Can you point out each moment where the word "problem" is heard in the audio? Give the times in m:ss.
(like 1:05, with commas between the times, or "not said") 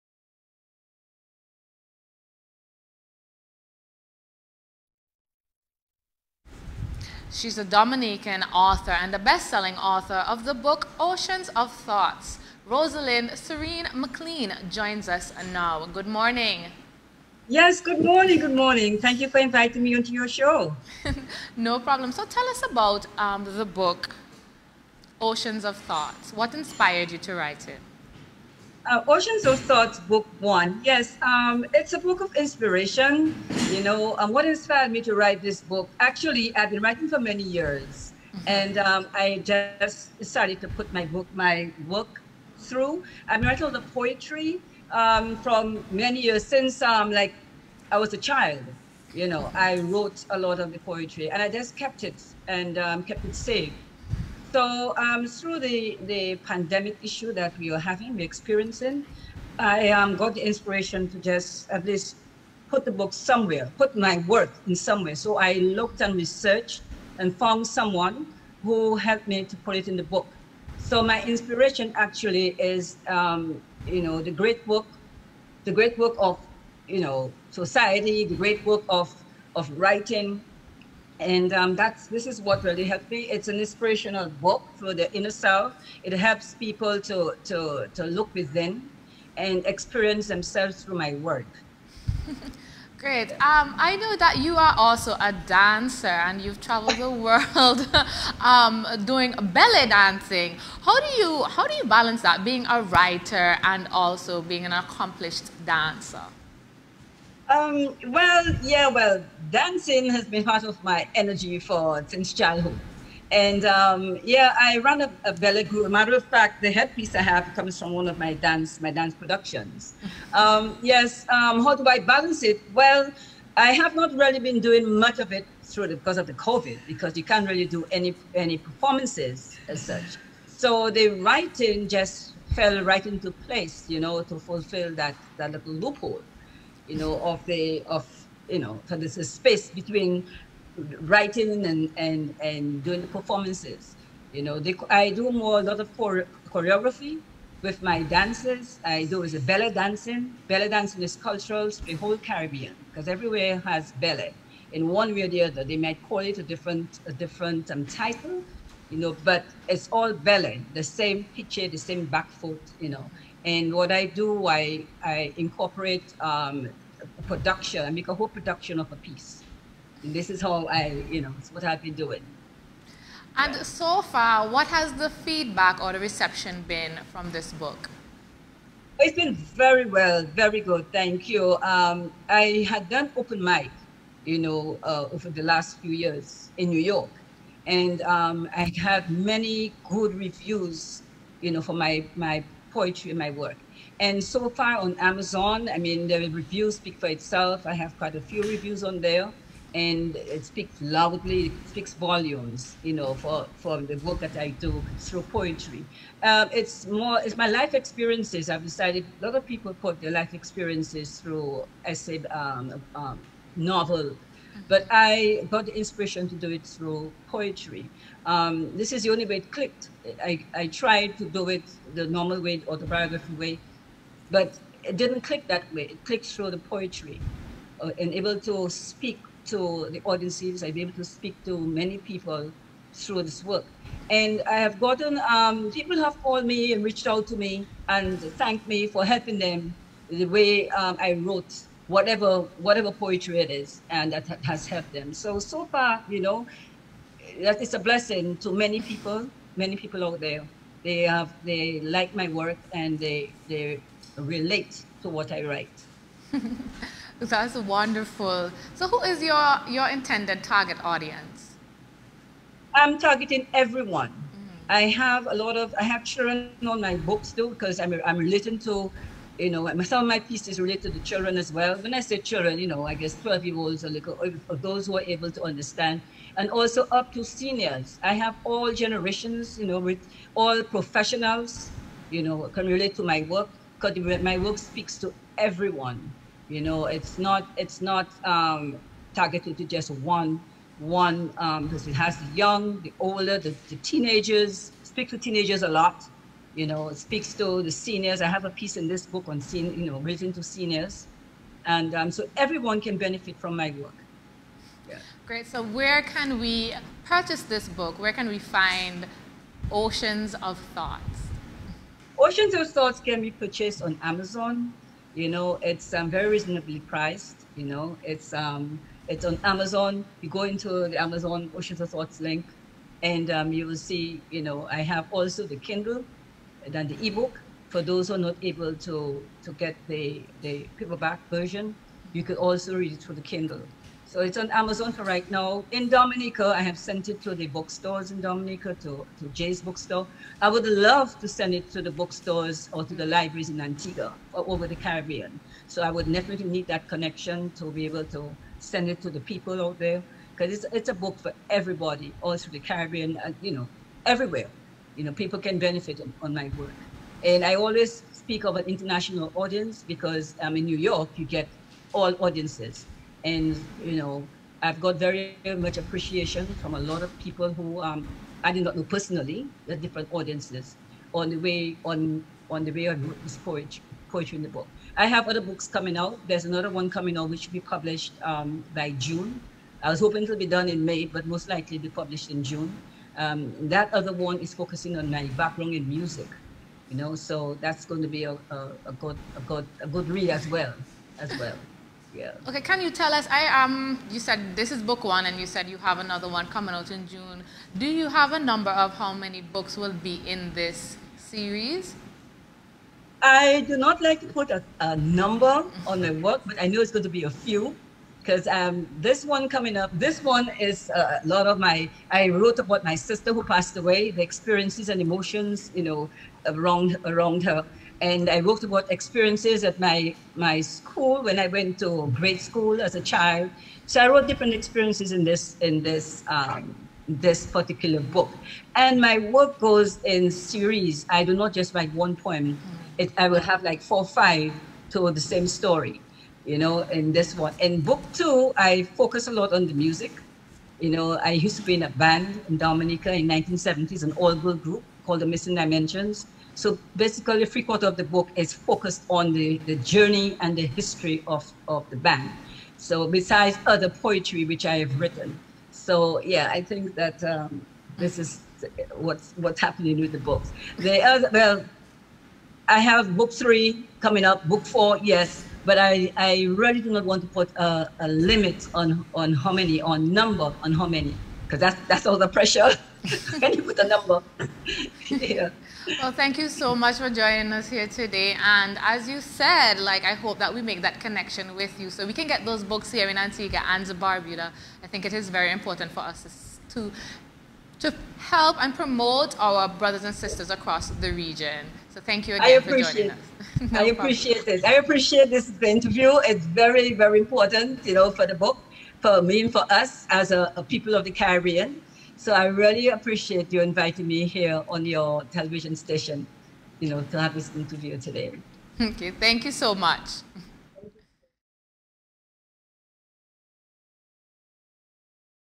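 0:21, 8:14.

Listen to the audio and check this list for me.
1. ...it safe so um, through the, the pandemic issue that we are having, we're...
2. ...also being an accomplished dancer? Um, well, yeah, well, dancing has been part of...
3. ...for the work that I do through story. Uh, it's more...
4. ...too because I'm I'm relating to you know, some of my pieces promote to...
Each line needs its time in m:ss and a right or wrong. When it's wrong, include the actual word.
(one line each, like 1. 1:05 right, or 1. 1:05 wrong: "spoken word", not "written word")
1. 0:53 right
2. 1:43 right
3. 3:23 wrong: "poetry", not "story"
4. 4:27 wrong: "relate", not "promote".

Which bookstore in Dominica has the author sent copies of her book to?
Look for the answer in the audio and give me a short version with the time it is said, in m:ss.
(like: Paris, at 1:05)
Jay's bookstore, at 5:39.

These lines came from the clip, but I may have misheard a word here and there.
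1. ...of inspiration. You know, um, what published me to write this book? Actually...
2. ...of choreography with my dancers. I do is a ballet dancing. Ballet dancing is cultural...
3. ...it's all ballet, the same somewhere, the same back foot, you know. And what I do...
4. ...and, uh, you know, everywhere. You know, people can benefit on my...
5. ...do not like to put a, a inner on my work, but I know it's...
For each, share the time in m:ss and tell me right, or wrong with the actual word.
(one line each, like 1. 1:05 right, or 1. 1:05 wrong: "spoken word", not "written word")
1. 0:32 wrong: "inspired", not "published"
2. 2:25 right
3. 2:39 wrong: "picture", not "somewhere"
4. 5:53 right
5. 6:43 wrong: "number", not "inner".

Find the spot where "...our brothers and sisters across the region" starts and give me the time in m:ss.
8:09.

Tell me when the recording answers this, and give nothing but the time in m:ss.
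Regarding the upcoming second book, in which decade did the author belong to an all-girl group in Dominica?
7:23.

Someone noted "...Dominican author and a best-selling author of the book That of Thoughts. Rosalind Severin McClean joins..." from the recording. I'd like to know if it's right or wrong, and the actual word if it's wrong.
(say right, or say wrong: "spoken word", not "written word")
wrong: "Oceans", not "That".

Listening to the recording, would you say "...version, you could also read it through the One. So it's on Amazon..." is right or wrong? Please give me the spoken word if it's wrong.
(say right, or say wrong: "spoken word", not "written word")
wrong: "Kindle", not "One".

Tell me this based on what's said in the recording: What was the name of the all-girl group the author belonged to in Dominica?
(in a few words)
Missing Dimensions.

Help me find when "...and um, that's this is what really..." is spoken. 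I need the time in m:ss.
1:21.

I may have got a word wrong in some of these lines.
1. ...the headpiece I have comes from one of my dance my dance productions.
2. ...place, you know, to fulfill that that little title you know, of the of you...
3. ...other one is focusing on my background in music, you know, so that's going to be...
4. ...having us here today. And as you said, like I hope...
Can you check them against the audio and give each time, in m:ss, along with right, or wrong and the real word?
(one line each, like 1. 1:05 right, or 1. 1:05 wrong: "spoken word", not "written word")
1. 1:56 right
2. 2:13 wrong: "loophole", not "title"
3. 6:23 right
4. 7:57 wrong: "joining", not "having".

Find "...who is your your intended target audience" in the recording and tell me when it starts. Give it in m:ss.
4:18.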